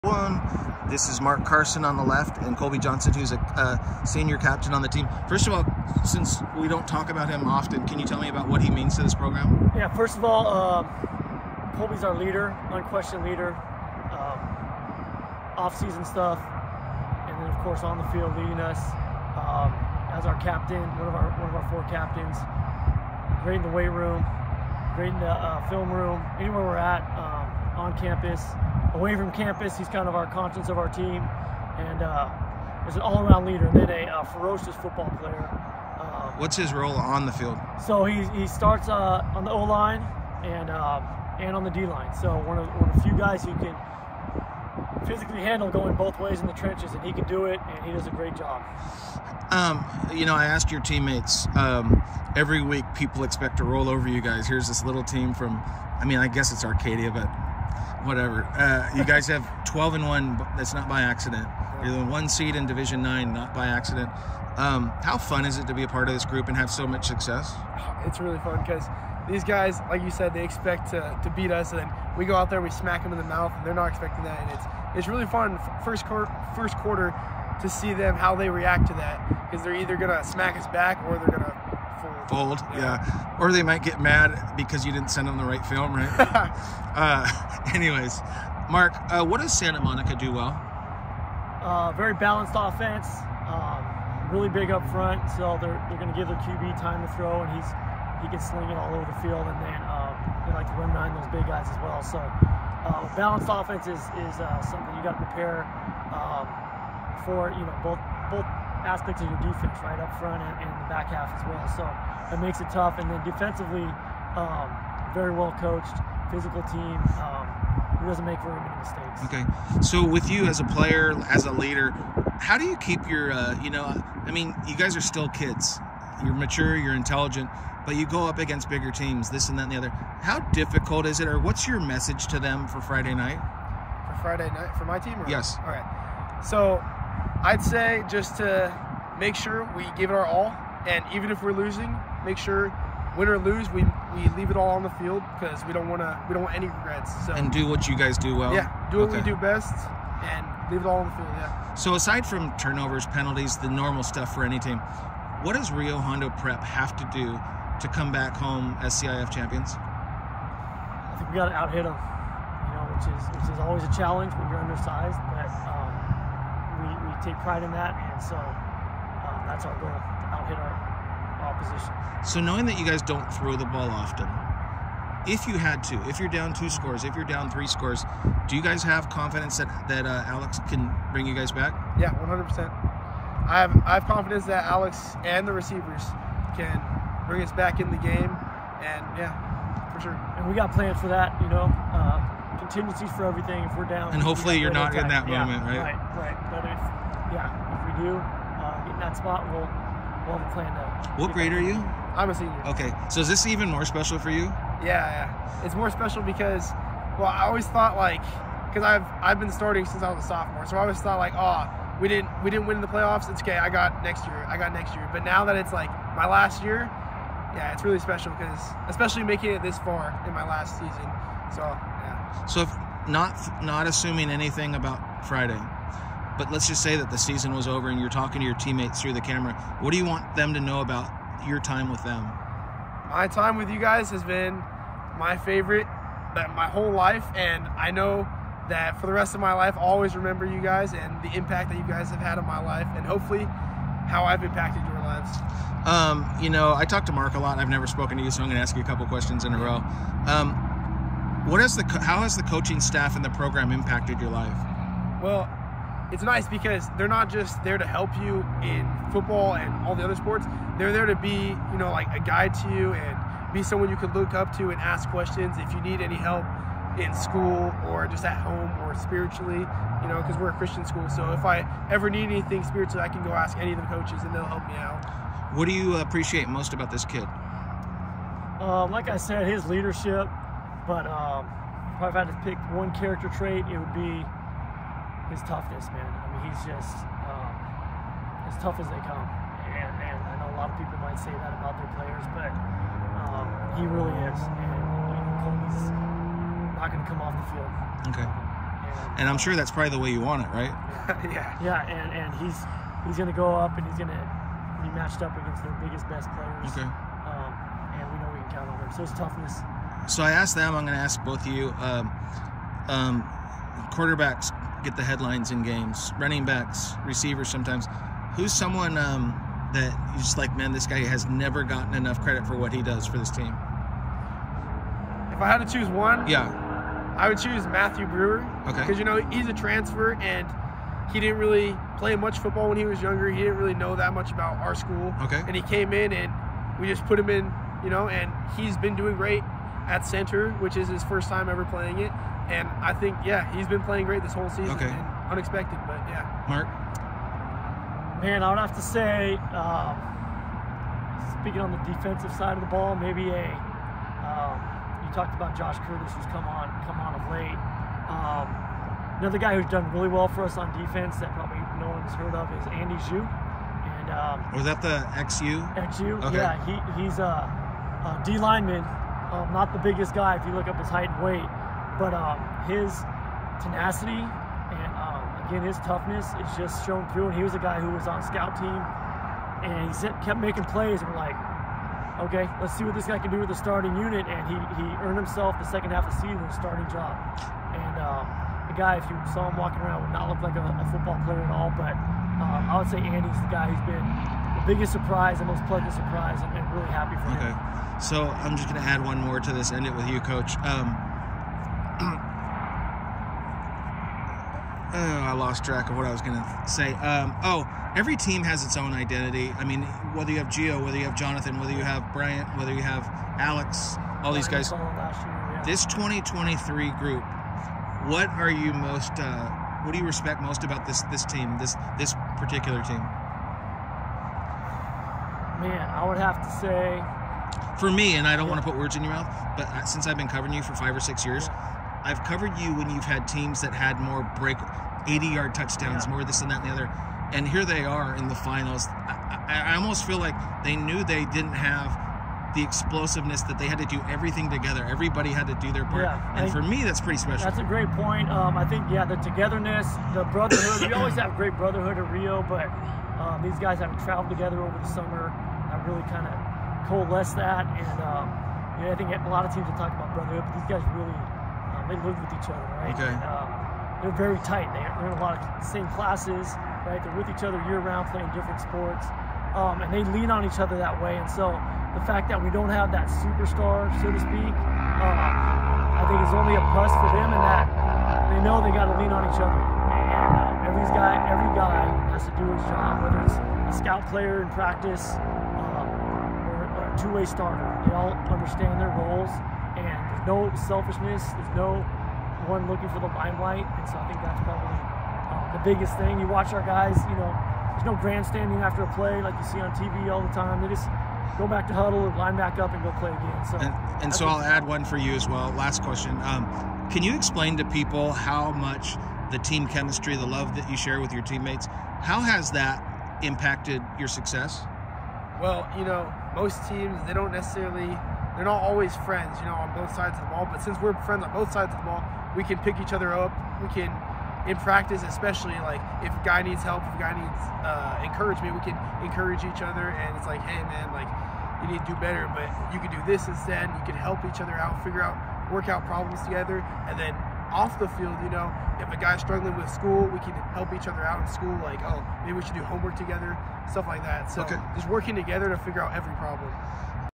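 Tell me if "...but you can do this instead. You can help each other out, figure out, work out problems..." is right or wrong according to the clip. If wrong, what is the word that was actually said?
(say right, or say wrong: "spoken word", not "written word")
right.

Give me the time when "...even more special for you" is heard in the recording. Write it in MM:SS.
03:23.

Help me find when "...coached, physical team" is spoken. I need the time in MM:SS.
01:55.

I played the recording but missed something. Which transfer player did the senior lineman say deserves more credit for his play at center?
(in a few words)
Matthew Brewer.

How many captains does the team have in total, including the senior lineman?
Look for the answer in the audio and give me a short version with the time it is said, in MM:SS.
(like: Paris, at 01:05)
4, at 00:21.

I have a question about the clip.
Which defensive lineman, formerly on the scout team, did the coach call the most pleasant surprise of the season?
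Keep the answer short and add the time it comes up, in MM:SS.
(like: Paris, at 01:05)
Andy Xu, at 06:02.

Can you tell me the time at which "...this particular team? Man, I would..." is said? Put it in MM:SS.
07:01.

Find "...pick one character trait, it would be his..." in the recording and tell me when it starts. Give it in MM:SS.
04:42.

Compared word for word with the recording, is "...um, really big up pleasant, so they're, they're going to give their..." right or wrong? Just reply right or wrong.
wrong.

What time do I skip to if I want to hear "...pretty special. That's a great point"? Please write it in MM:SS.
07:26.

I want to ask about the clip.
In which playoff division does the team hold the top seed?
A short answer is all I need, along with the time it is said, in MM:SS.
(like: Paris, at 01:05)
Division 9, at 01:02.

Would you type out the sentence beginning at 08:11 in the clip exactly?
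There's no one looking for the limelight, and so I think that's probably um, the biggest thing.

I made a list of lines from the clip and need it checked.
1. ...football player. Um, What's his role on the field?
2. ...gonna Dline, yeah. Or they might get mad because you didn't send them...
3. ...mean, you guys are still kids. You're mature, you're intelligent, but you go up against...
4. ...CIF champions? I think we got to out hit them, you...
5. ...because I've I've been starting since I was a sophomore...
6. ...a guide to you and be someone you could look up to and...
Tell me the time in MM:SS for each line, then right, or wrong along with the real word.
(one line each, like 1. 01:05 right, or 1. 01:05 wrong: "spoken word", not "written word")
1. 00:34 right
2. 01:21 wrong: "Fold", not "Dline"
3. 02:04 right
4. 02:39 right
5. 03:28 right
6. 04:22 right.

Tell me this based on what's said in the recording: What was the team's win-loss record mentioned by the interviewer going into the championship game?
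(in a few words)
12 and 1.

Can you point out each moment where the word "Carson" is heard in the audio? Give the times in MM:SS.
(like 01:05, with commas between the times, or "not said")
00:01.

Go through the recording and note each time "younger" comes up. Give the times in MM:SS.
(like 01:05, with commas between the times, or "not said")
05:33.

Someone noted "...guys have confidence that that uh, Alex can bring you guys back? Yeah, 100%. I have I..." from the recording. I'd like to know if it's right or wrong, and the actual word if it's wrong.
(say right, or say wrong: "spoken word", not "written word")
right.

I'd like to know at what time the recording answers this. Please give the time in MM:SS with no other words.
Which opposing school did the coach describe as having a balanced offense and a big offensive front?
01:29.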